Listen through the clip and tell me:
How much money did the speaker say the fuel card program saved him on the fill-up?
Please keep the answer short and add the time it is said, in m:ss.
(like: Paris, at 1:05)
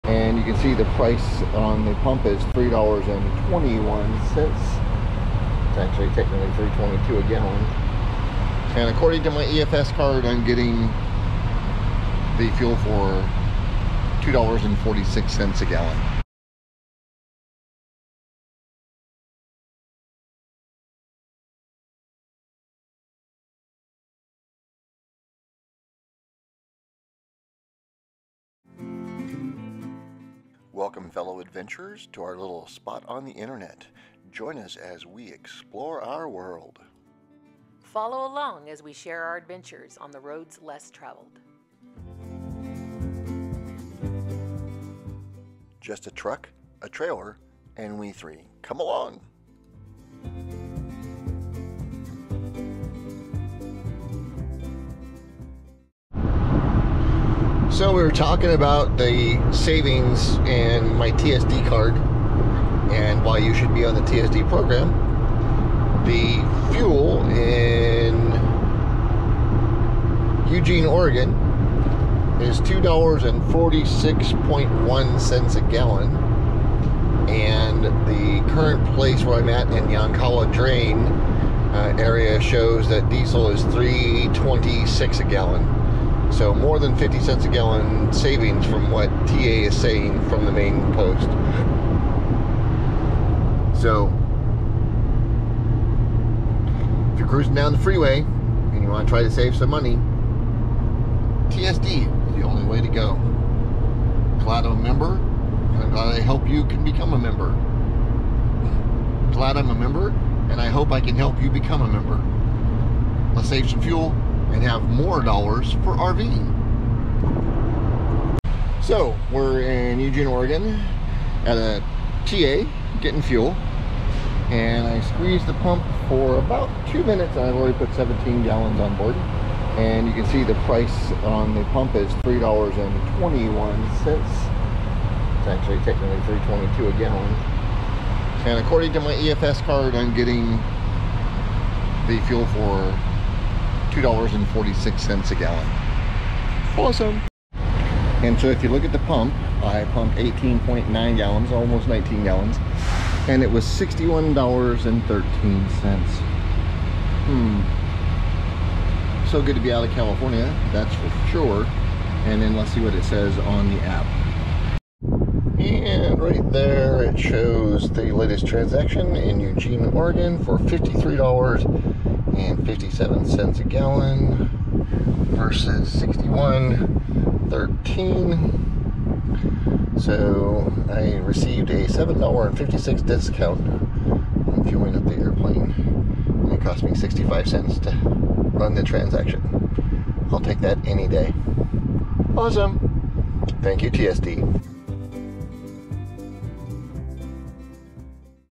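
$7.56, at 3:01.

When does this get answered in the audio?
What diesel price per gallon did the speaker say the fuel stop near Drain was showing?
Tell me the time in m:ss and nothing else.
1:23.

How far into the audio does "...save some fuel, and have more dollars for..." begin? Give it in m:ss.
1:53.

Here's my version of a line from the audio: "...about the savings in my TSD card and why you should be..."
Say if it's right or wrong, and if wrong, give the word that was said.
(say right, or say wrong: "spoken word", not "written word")
right.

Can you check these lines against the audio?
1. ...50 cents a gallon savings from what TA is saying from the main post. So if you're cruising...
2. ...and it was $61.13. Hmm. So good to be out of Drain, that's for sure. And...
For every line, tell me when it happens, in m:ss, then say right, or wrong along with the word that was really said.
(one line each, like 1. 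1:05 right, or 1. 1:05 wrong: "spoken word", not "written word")
1. 1:26 right
2. 2:33 wrong: "California", not "Drain".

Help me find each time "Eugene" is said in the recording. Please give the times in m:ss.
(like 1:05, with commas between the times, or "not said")
1:10, 1:59, 2:49.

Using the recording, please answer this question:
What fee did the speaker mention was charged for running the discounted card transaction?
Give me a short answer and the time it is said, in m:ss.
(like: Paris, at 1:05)
65 cents, at 3:06.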